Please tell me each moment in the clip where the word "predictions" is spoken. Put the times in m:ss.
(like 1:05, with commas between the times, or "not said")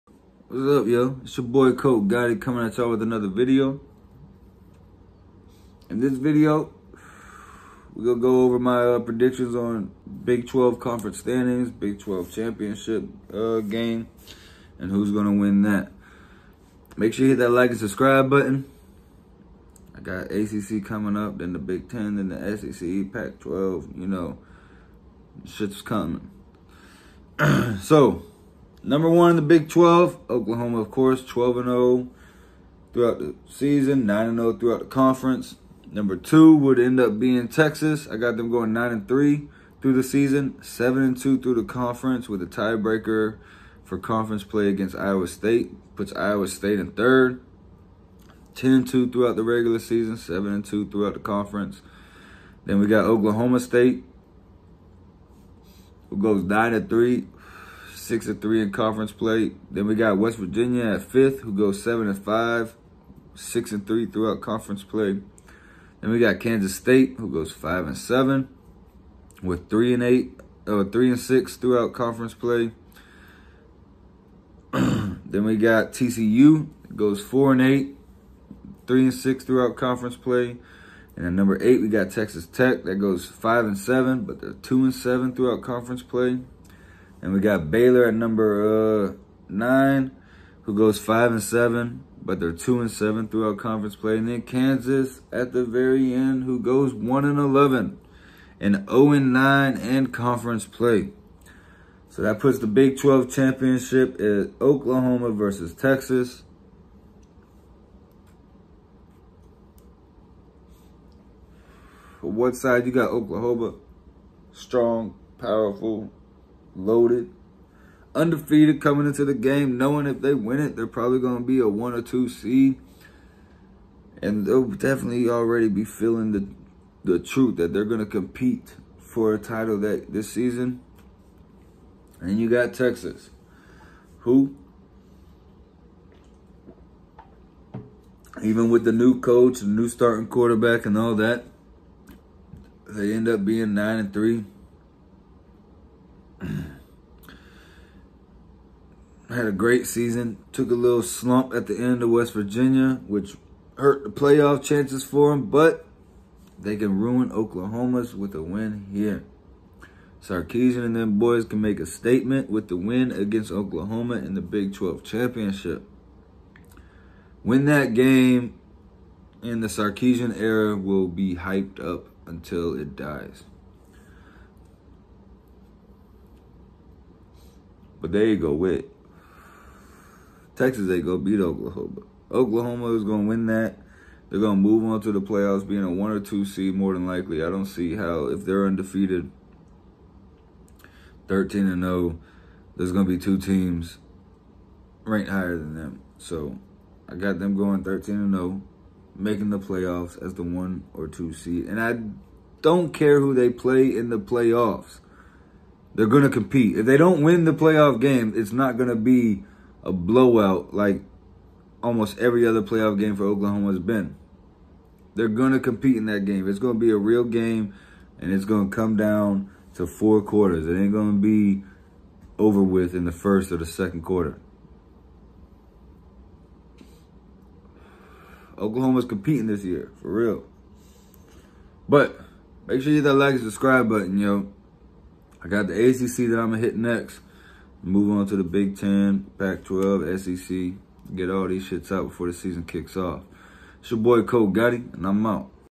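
0:08.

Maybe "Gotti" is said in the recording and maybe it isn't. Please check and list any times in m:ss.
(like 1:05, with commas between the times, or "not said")
0:02, 4:04.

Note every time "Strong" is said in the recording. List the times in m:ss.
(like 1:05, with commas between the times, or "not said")
1:54.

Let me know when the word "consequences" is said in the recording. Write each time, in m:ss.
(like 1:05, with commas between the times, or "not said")
not said.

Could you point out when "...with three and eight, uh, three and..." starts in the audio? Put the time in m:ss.
1:09.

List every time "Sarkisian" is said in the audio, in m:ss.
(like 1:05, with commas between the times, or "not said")
2:40, 2:49.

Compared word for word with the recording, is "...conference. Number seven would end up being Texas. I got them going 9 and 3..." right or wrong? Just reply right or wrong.
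wrong.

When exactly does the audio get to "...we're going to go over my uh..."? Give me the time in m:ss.
0:07.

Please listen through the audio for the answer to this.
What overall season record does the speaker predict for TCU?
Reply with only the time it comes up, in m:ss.
1:17.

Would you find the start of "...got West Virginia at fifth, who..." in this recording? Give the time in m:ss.
0:59.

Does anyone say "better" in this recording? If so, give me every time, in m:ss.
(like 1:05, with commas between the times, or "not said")
not said.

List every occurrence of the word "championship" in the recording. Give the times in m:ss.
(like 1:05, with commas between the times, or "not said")
0:12, 1:43, 2:45.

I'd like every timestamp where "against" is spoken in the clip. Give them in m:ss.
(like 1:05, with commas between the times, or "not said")
0:44, 2:43.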